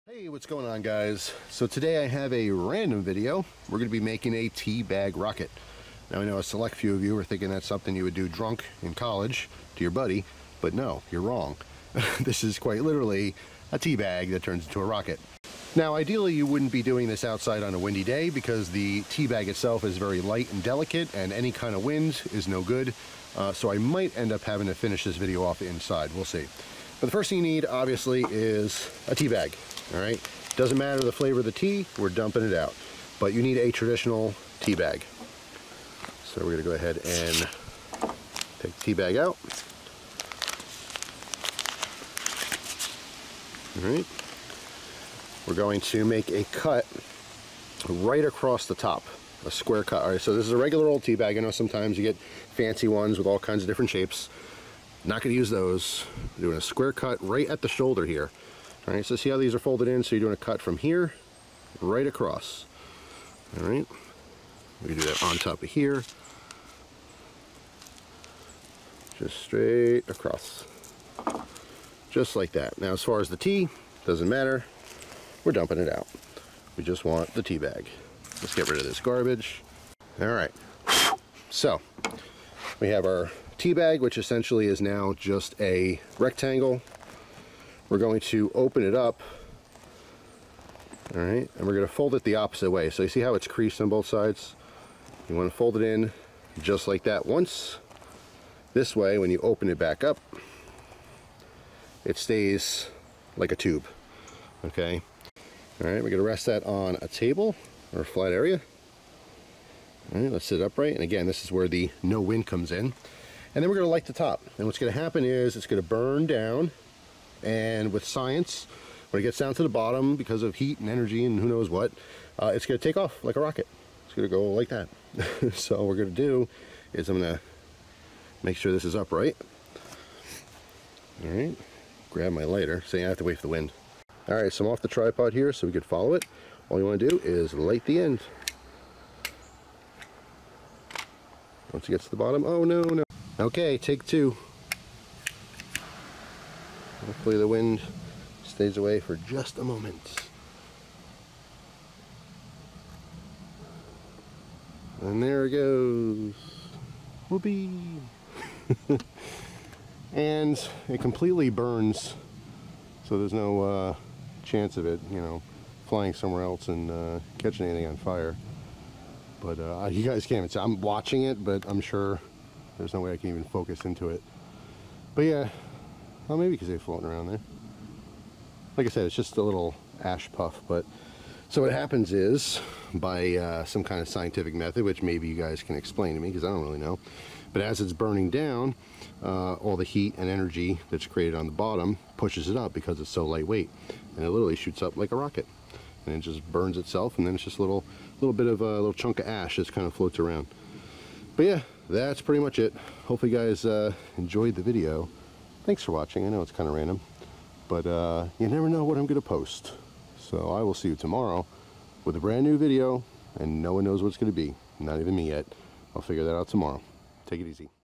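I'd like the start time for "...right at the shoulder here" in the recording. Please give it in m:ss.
0:57.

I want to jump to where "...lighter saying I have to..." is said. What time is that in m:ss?
2:12.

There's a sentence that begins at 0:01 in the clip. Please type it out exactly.
So today I have a random video.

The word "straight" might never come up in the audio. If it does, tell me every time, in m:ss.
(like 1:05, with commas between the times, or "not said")
1:09.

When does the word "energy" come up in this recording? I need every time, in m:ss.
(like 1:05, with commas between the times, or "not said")
2:00, 3:10.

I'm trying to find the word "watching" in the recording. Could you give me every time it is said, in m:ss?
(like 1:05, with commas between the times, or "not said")
2:50, 3:25.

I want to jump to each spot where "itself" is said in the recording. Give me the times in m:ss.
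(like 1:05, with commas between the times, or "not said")
0:19, 3:16.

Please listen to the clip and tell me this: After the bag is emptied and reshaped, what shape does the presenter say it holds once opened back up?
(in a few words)
A tube.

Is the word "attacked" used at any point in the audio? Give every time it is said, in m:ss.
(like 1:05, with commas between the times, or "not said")
not said.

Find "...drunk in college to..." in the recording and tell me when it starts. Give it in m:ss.
0:08.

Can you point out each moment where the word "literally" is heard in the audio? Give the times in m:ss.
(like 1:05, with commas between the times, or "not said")
0:12, 3:14.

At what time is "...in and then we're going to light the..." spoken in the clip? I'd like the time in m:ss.
1:52.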